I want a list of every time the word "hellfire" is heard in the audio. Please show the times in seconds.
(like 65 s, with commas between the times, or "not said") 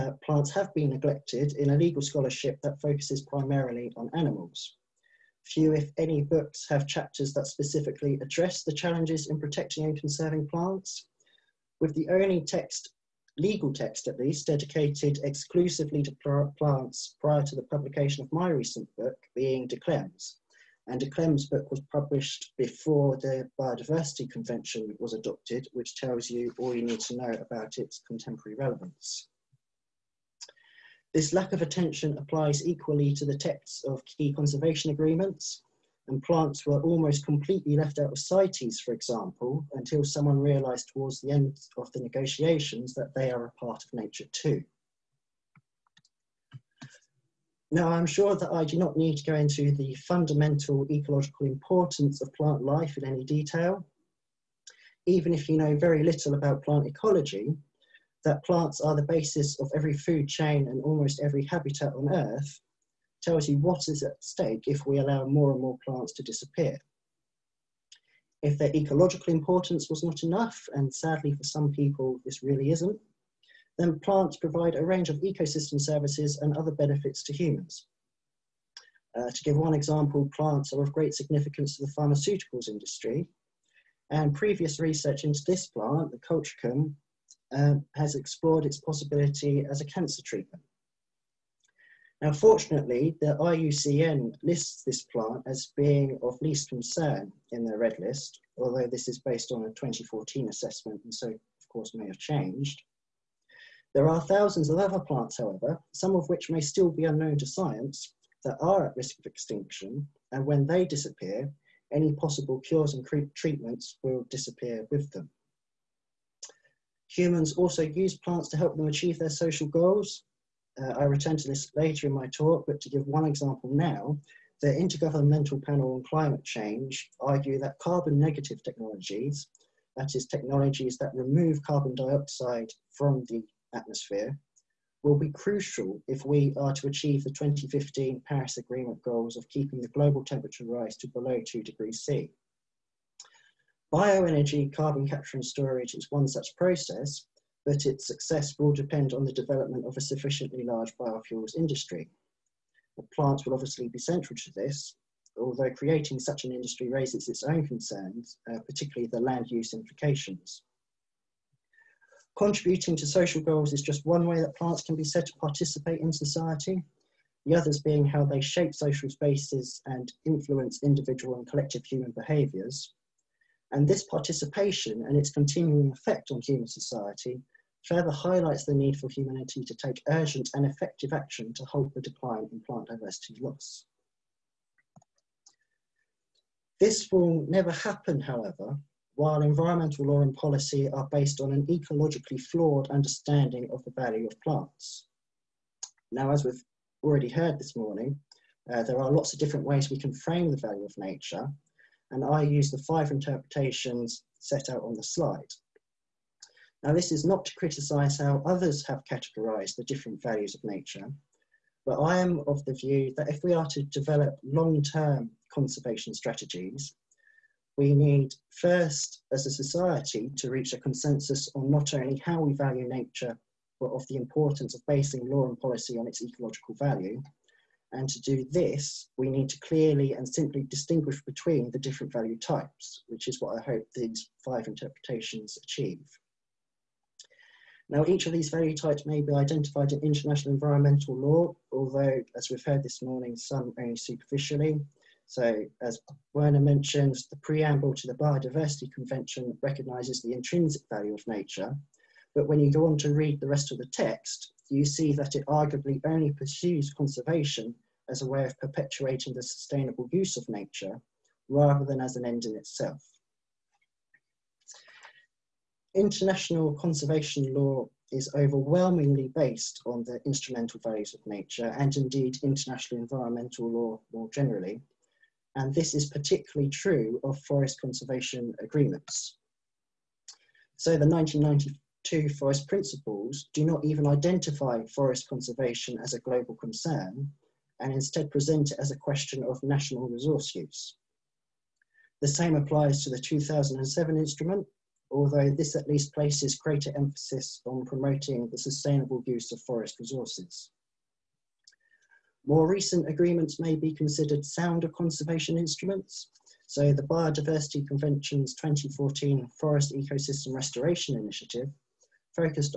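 not said.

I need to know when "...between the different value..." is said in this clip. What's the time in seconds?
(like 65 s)
231 s.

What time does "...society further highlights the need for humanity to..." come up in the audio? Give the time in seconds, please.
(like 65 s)
176 s.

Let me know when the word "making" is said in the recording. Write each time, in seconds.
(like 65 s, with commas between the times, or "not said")
not said.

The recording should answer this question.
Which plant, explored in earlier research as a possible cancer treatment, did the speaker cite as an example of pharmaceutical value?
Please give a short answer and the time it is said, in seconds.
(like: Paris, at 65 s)
colchicum, at 86 s.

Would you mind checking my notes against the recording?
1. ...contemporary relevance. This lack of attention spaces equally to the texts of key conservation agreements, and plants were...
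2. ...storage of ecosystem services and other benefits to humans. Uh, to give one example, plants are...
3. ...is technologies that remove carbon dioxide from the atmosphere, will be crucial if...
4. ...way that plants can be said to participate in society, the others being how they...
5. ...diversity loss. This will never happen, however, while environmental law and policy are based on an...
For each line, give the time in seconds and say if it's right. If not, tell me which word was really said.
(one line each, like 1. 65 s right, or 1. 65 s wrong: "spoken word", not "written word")
1. 28 s wrong: "applies", not "spaces"
2. 74 s wrong: "range", not "storage"
3. 130 s right
4. 164 s right
5. 182 s right.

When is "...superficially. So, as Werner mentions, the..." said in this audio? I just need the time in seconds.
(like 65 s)
243 s.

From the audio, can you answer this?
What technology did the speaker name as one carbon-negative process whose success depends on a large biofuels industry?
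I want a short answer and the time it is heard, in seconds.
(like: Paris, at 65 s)
Bioenergy carbon capture and storage, at 143 s.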